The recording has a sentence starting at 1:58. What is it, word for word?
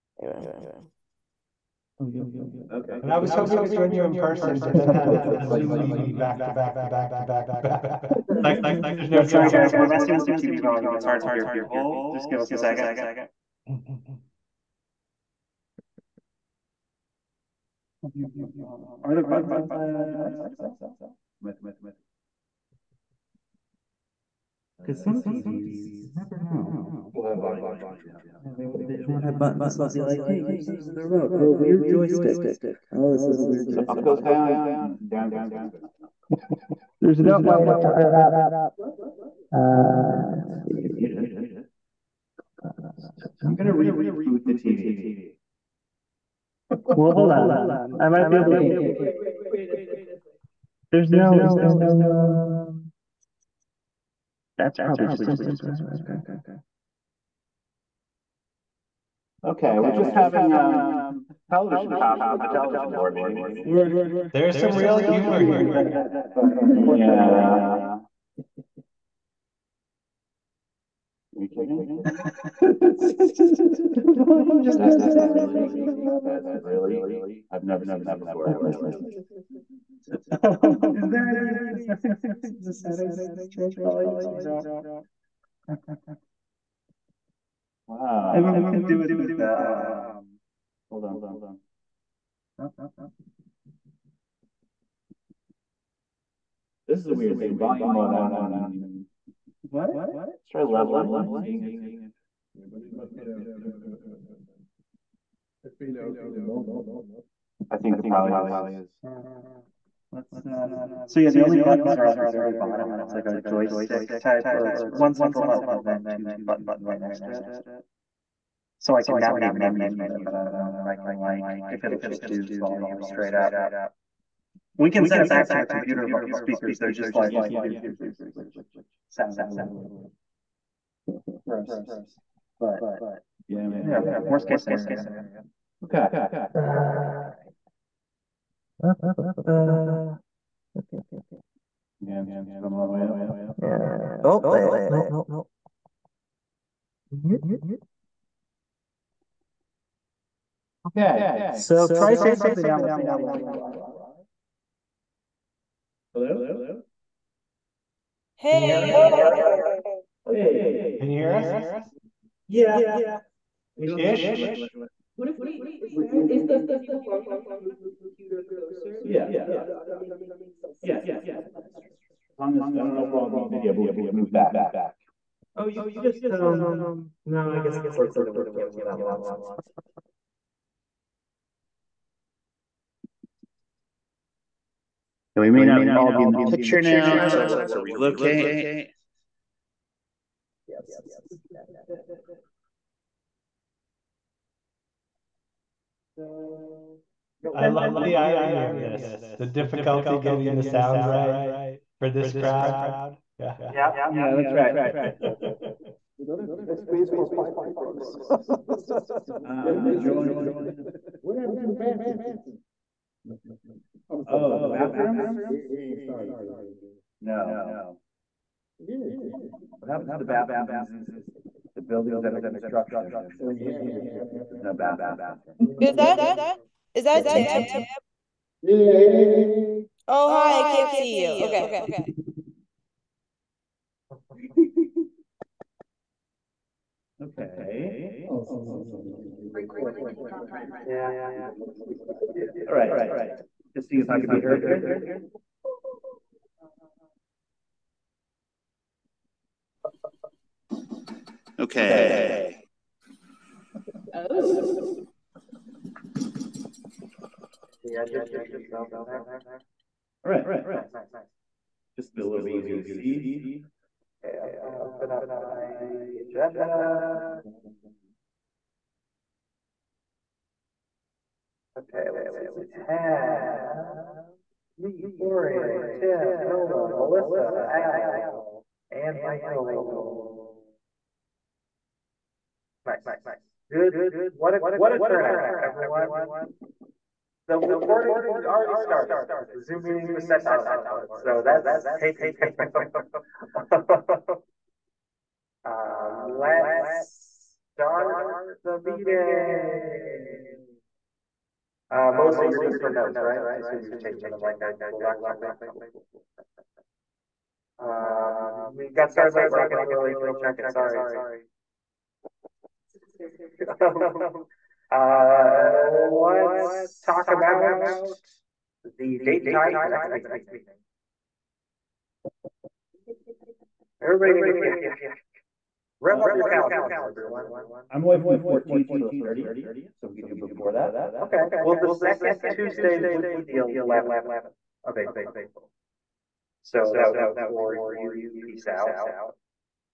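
So I can navigate menus with it, but I don't know if I can like if it'll just do volume straight up.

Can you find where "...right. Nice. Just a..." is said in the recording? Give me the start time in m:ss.
4:20.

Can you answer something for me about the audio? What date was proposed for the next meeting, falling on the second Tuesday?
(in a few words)
11th of April.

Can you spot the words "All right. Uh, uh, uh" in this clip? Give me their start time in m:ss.
2:16.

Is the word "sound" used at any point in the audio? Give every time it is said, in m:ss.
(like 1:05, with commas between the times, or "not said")
2:09, 3:20.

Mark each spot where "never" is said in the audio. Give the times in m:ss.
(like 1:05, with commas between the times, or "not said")
0:26, 1:17.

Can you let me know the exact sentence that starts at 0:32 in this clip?
Oh, this is a weird joystick.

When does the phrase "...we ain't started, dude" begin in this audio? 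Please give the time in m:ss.
3:35.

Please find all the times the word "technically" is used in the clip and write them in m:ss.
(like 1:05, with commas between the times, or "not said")
not said.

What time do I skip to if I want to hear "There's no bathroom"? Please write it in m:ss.
3:44.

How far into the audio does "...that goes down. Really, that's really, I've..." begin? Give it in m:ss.
1:14.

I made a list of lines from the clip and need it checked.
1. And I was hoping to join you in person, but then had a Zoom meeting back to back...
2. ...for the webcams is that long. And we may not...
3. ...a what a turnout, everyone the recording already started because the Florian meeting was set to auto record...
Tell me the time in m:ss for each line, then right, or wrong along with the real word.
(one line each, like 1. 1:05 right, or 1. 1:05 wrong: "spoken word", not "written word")
1. 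0:03 right
2. 2:58 right
3. 4:44 wrong: "Zoom", not "Florian".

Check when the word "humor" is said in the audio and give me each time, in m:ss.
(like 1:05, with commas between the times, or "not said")
1:04.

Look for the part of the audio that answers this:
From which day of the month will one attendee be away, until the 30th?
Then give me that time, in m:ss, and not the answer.
5:28.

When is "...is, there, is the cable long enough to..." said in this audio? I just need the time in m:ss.
2:45.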